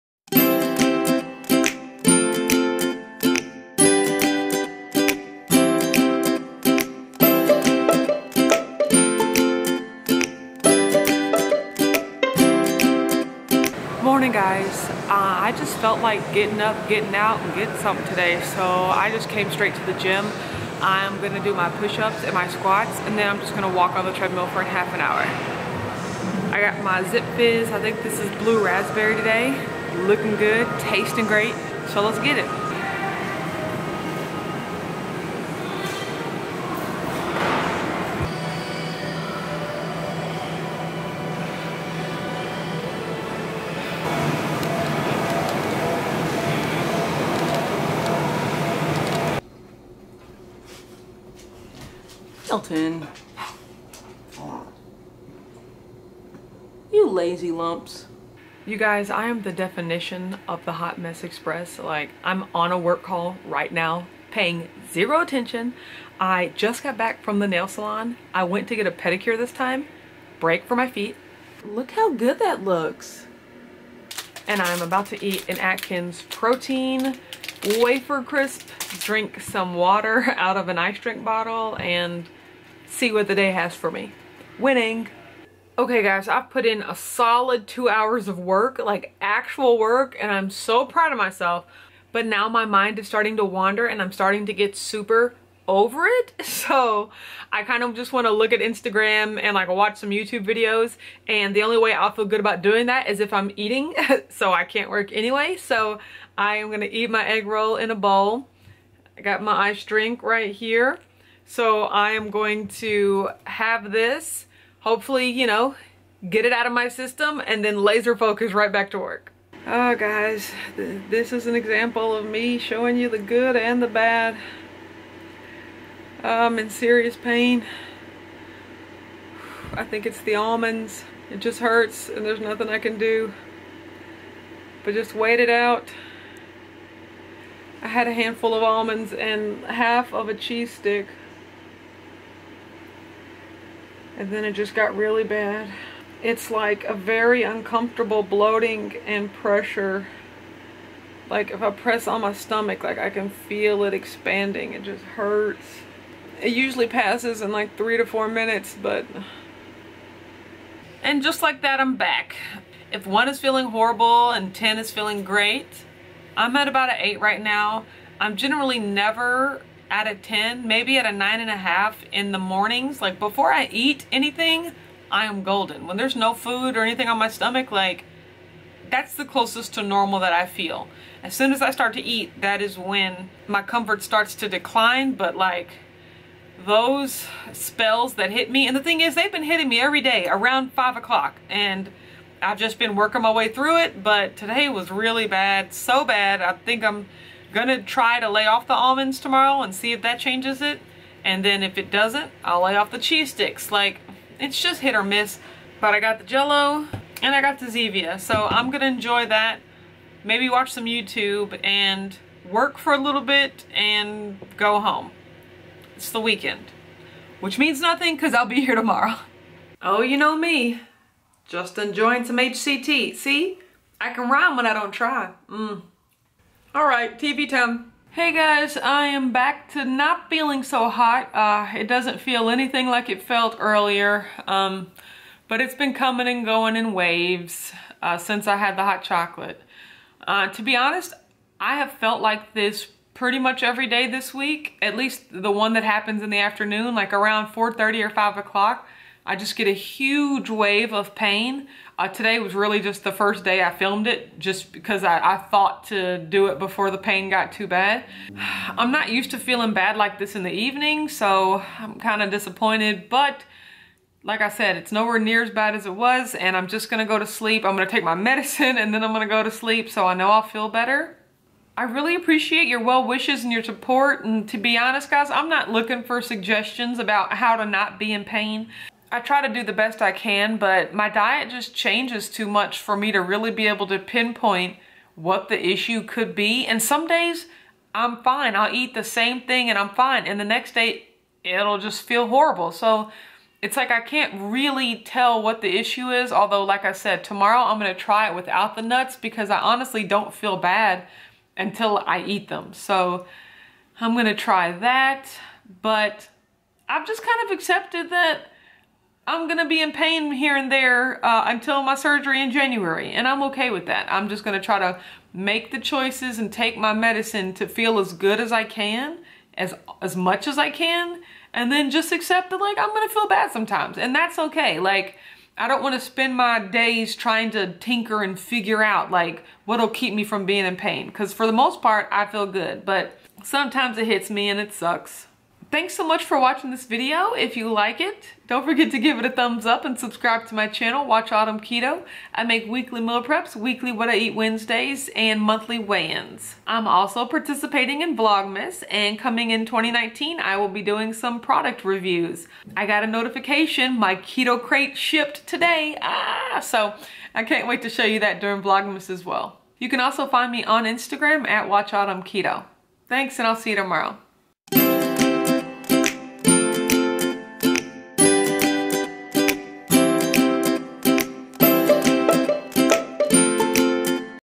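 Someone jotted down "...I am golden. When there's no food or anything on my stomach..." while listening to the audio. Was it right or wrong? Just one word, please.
right.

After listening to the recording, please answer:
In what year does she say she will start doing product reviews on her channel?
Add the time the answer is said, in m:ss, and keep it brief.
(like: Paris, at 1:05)
2019, at 5:49.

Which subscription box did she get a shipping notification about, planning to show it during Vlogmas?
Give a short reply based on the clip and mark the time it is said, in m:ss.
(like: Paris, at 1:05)
Keto Krate, at 5:54.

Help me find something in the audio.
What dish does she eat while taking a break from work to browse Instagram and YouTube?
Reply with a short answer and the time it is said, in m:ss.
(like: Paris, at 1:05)
Egg roll in a bowl, at 1:47.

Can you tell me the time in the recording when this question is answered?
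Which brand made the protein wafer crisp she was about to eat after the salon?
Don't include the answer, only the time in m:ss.
1:15.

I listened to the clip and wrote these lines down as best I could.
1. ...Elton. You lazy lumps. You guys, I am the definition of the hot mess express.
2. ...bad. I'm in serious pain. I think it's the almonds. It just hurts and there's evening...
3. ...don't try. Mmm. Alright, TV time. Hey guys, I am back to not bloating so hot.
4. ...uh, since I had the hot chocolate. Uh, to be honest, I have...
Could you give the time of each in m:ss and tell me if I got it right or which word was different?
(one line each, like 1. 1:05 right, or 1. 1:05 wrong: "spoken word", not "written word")
1. 0:52 right
2. 2:04 wrong: "nothing", not "evening"
3. 3:44 wrong: "feeling", not "bloating"
4. 3:58 right.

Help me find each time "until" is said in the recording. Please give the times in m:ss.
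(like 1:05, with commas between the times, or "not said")
5:01, 5:11.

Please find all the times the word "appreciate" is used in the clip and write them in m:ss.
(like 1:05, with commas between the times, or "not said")
4:32.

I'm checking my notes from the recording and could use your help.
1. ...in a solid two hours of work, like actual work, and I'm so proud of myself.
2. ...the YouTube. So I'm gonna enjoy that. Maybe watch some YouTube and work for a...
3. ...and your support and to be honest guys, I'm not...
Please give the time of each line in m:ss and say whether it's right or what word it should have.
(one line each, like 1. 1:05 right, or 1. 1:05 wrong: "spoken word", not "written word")
1. 1:26 right
2. 3:27 wrong: "Zevia", not "YouTube"
3. 4:33 right.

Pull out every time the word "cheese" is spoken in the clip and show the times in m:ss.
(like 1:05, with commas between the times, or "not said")
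2:20, 3:22.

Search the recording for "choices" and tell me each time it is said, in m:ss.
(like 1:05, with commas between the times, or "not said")
5:15.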